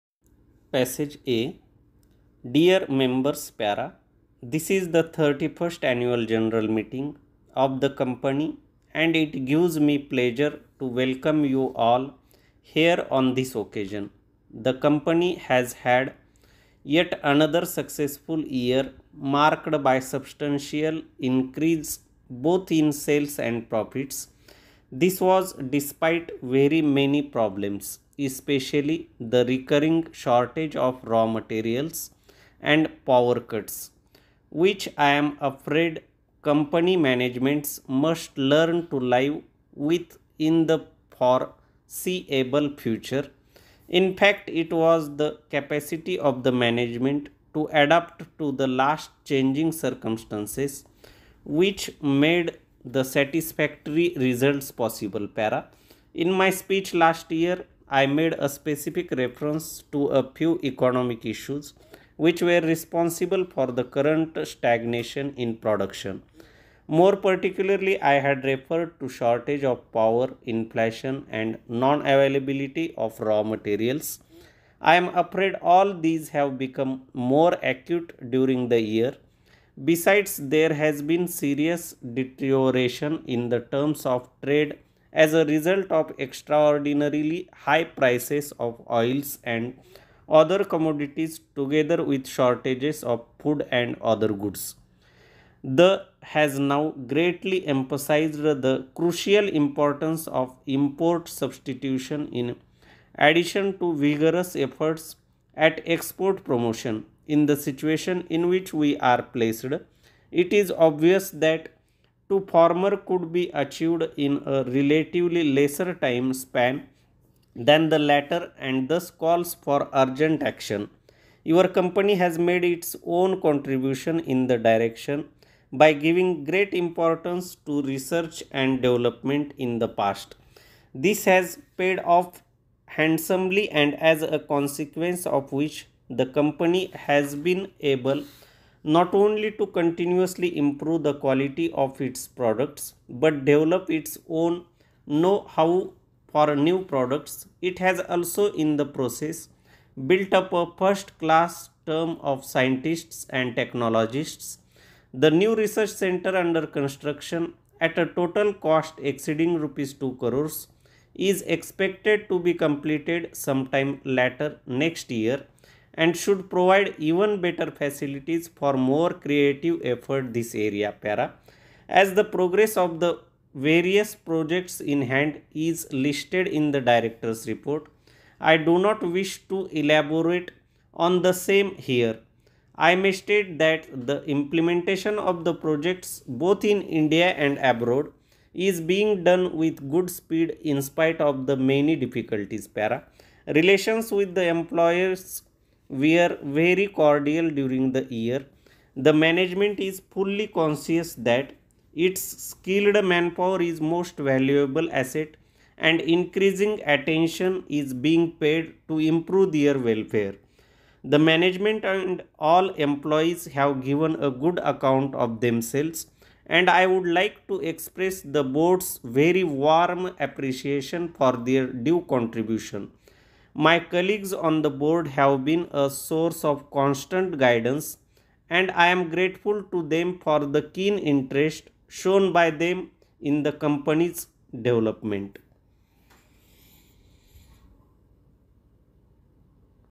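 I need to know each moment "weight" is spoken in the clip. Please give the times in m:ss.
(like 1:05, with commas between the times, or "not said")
not said.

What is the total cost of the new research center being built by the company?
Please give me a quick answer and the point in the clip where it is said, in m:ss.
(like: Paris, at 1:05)
Over Rs 2 crores, at 2:39.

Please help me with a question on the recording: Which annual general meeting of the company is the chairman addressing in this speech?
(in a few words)
31st.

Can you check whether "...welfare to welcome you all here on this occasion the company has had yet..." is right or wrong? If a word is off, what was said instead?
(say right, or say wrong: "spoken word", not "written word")
wrong: "pleasure", not "welfare".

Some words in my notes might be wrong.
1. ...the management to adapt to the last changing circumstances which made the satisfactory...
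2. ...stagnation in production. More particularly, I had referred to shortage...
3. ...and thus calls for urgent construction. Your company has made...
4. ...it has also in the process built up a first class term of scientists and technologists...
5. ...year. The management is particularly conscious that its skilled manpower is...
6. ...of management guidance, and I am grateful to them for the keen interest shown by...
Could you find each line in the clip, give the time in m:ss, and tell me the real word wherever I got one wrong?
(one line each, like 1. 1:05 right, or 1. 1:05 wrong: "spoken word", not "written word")
1. 0:46 right
2. 1:04 right
3. 1:58 wrong: "action", not "construction"
4. 2:27 right
5. 3:18 wrong: "fully", not "particularly"
6. 3:46 wrong: "constant", not "management".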